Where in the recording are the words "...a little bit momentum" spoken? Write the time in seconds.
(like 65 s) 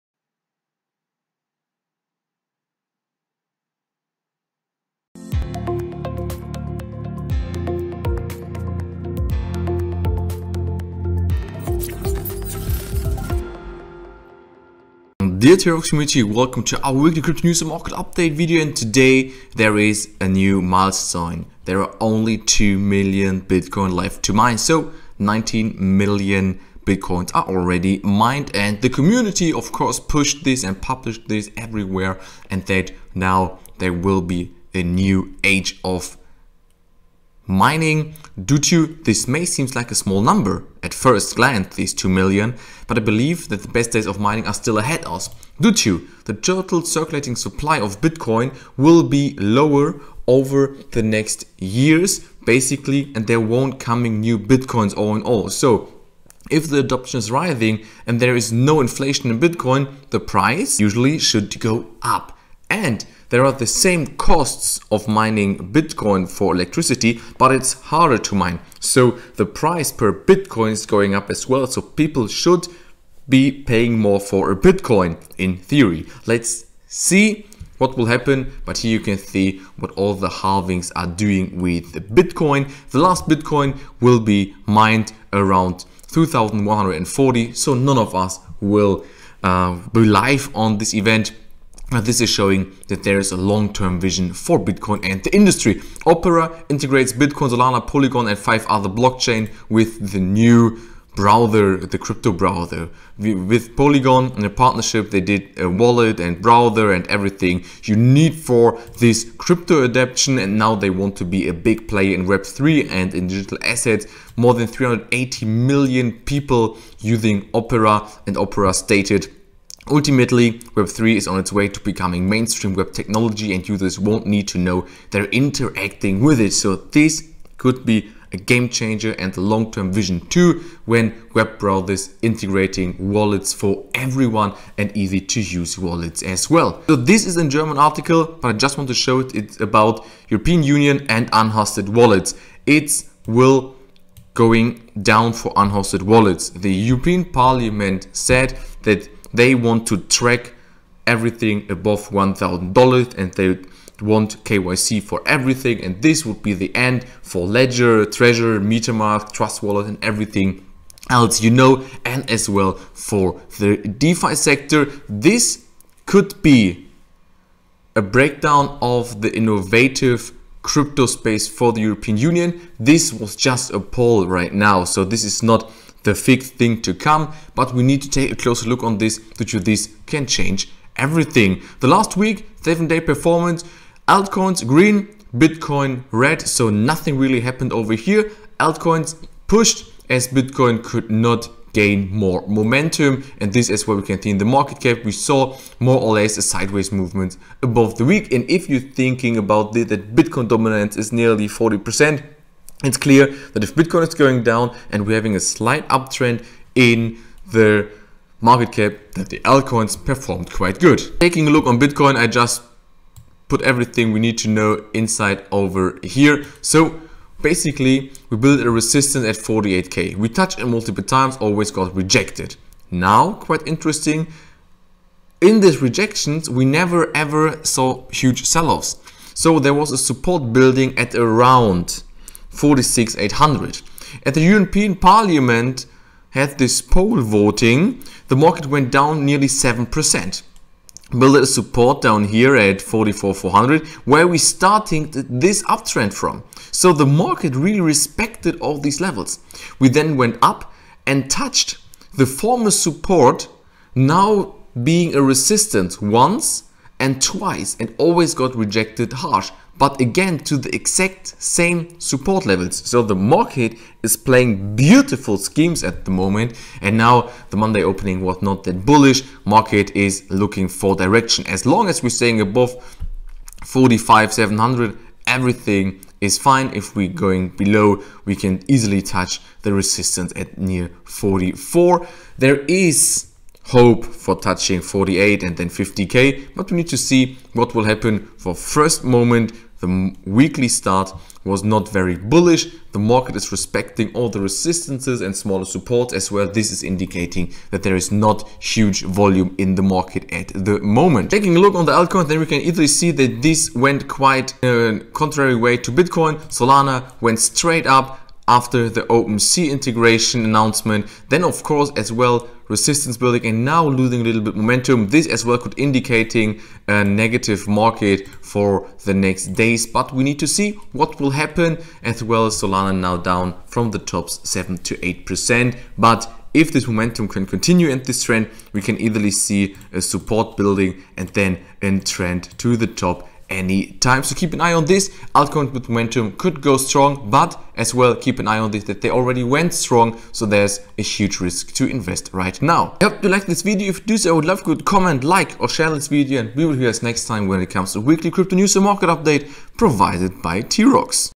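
314 s.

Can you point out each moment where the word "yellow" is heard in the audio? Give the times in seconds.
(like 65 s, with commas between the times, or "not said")
not said.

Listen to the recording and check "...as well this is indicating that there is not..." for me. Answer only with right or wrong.
right.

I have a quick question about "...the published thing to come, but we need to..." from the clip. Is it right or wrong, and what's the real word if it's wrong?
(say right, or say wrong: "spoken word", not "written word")
wrong: "fixed", not "published".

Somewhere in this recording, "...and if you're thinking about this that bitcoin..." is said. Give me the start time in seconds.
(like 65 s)
198 s.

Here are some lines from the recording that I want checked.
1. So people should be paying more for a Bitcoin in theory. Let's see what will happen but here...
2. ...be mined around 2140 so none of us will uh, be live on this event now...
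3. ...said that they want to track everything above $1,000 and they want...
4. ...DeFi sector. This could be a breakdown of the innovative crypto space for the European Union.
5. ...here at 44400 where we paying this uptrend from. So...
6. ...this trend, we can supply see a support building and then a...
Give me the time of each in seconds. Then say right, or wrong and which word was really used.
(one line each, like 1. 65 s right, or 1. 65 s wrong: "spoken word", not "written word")
1. 71 s right
2. 84 s right
3. 148 s right
4. 163 s right
5. 242 s wrong: "starting", not "paying"
6. 328 s wrong: "easily", not "supply".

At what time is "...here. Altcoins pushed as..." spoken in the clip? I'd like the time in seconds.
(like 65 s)
187 s.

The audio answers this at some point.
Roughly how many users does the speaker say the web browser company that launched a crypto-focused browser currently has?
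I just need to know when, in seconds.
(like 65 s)
114 s.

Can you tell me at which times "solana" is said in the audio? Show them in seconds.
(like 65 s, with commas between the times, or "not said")
97 s, 306 s, 322 s.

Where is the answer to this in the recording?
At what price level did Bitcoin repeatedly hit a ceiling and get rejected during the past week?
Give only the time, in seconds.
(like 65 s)
219 s.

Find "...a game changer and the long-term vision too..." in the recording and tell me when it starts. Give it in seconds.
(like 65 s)
128 s.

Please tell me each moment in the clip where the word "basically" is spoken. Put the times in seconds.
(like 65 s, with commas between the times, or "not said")
52 s, 217 s.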